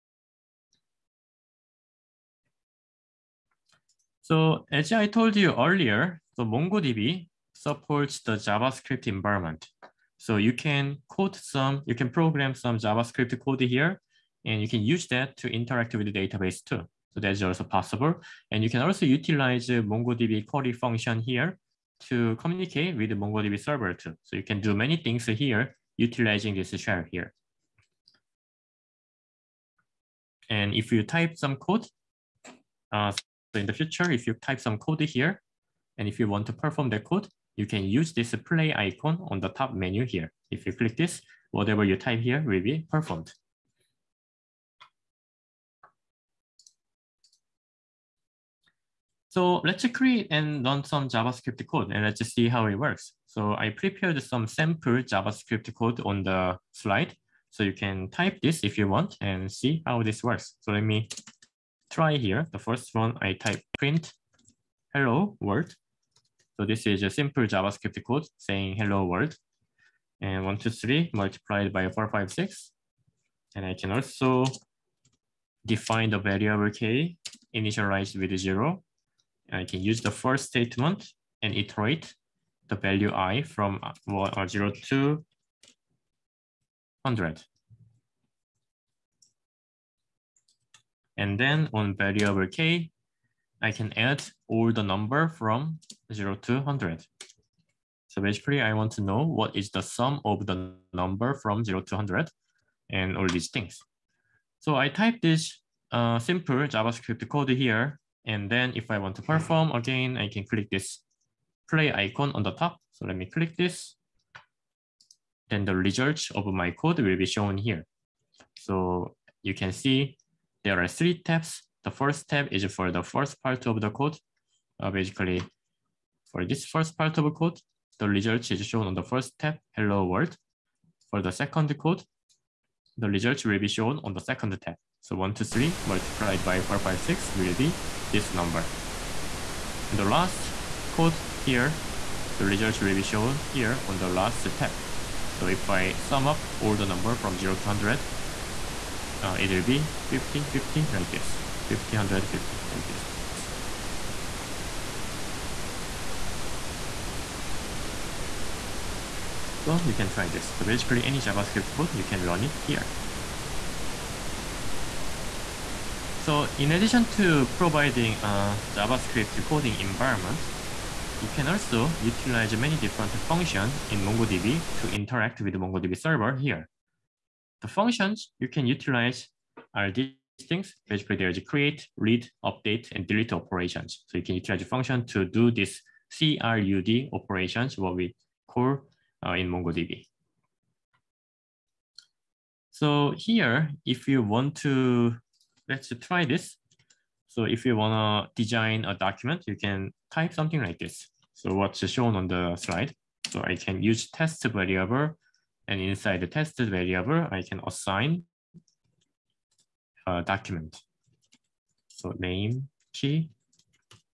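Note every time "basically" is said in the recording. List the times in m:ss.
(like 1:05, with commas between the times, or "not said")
1:38, 2:04, 2:40, 3:00.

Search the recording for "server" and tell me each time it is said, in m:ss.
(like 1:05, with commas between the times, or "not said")
0:23, 2:55.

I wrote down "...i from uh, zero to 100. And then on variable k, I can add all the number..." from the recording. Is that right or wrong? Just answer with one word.
right.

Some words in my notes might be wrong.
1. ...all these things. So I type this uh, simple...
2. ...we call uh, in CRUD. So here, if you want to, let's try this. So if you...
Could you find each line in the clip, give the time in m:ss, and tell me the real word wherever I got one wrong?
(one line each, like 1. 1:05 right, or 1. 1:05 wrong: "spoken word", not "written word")
1. 1:43 right
2. 3:07 wrong: "MongoDB", not "CRUD".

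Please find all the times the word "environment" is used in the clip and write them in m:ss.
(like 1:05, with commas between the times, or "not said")
0:09, 2:49.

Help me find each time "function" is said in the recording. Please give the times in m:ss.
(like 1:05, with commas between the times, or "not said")
0:20, 2:53, 2:57, 3:04.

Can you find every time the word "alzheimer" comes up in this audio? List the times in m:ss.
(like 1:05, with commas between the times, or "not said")
not said.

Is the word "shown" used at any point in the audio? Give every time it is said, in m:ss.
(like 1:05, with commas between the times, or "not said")
1:57, 2:08, 2:13, 2:23, 3:21.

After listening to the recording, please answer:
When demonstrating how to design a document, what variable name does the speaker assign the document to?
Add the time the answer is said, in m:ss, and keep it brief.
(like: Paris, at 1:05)
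test, at 3:24.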